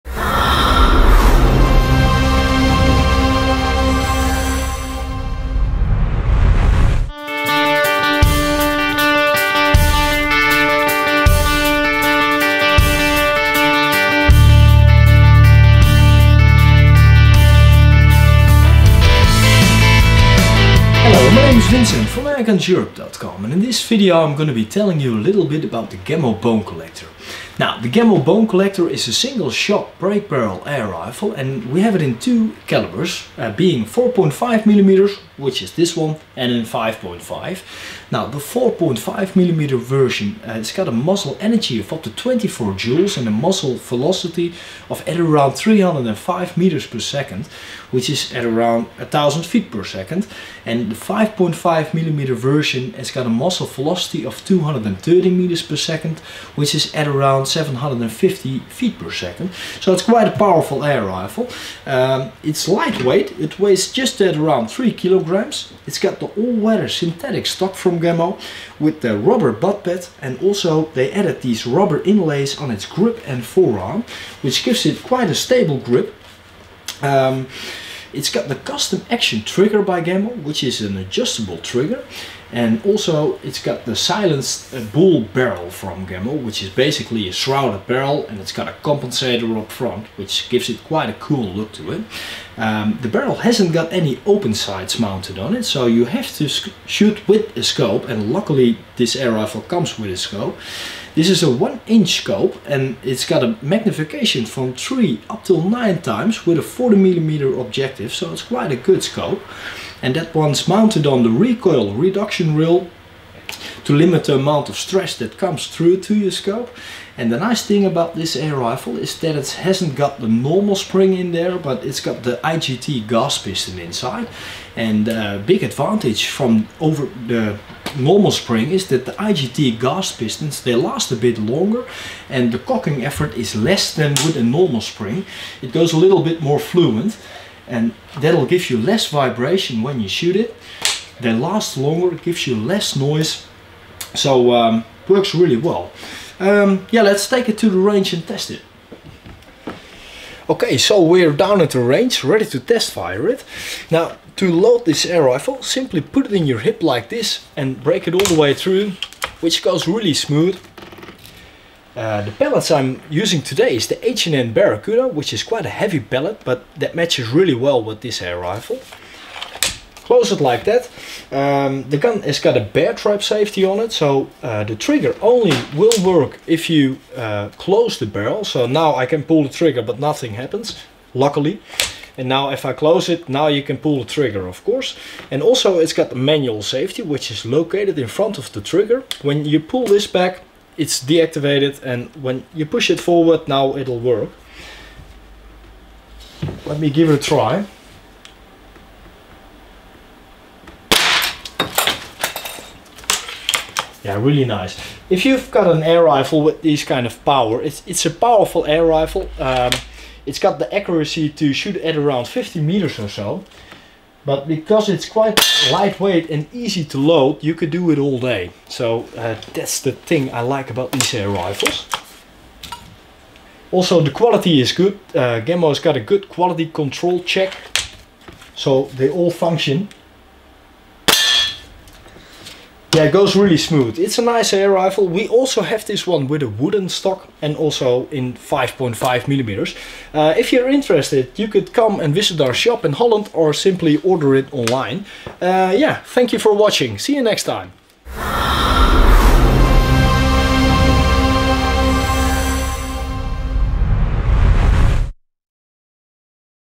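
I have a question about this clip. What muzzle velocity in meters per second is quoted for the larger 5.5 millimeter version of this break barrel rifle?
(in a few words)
230 meters per second.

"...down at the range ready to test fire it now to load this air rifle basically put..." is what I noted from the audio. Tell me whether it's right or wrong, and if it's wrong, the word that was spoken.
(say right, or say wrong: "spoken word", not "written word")
wrong: "simply", not "basically".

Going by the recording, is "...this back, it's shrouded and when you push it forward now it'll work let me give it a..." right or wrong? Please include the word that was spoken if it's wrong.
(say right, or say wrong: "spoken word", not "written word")
wrong: "deactivated", not "shrouded".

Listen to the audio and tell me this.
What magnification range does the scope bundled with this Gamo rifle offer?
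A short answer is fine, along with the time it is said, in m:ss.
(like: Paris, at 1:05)
3 to 9 times, at 1:44.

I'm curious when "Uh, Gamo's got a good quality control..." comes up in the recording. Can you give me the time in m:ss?
3:45.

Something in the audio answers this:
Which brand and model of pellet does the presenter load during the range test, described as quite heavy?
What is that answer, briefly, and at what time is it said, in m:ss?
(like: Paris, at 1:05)
H&N Barracuda, at 2:44.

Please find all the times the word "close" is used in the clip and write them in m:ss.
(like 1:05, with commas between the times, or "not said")
2:50, 2:57, 3:02.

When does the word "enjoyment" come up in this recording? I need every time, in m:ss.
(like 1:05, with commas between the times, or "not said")
not said.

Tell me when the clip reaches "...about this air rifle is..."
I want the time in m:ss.
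1:57.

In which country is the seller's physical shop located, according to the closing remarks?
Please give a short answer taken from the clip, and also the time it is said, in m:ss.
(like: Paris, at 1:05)
Holland, at 4:02.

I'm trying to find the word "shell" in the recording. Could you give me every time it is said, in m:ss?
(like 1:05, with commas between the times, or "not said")
not said.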